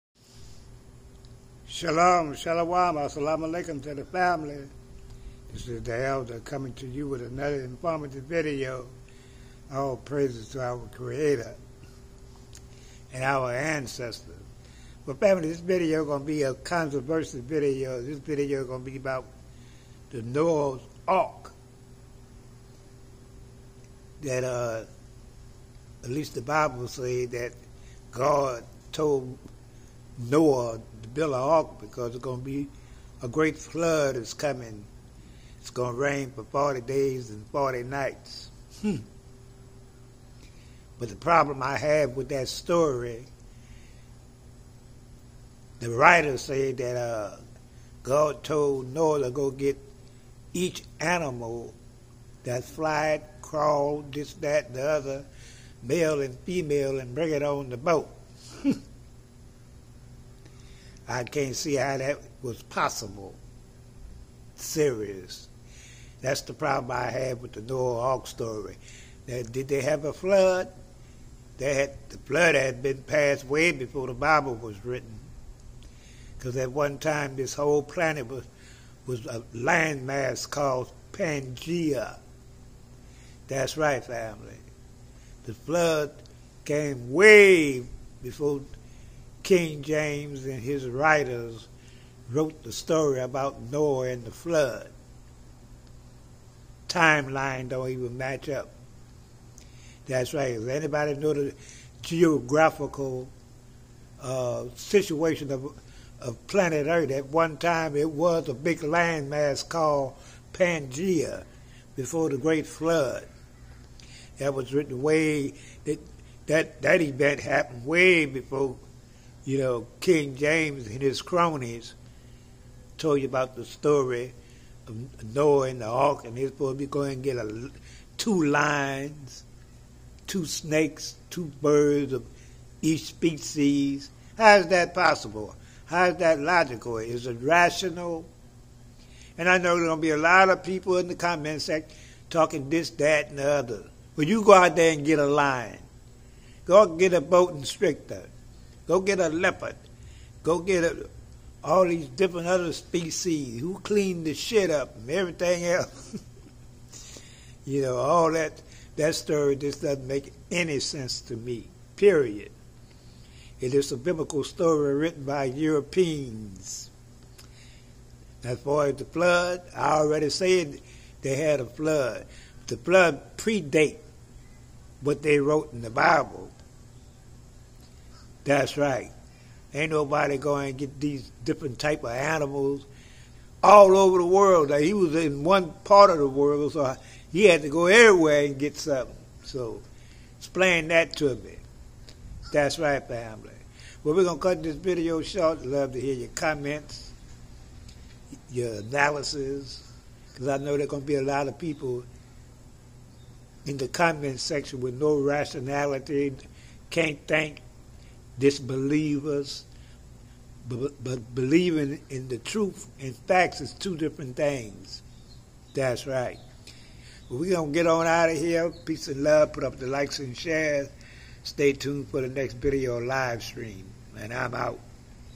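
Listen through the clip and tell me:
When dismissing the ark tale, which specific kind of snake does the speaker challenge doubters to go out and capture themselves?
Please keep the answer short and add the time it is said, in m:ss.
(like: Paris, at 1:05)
boa constrictor, at 2:27.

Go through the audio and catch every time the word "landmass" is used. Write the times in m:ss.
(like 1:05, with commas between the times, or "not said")
1:19, 1:48.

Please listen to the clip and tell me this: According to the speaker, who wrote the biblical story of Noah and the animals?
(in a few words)
Europeans.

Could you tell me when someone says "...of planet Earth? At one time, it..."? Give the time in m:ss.
1:46.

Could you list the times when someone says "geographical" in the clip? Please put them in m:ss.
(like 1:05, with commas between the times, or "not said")
1:42.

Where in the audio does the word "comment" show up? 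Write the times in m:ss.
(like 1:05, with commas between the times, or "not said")
2:21, 3:16, 3:23.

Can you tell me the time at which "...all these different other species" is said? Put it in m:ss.
2:31.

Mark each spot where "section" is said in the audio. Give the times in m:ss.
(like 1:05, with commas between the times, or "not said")
2:21, 3:24.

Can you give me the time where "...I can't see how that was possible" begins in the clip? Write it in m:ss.
1:01.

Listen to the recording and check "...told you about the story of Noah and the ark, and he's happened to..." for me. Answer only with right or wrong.
wrong.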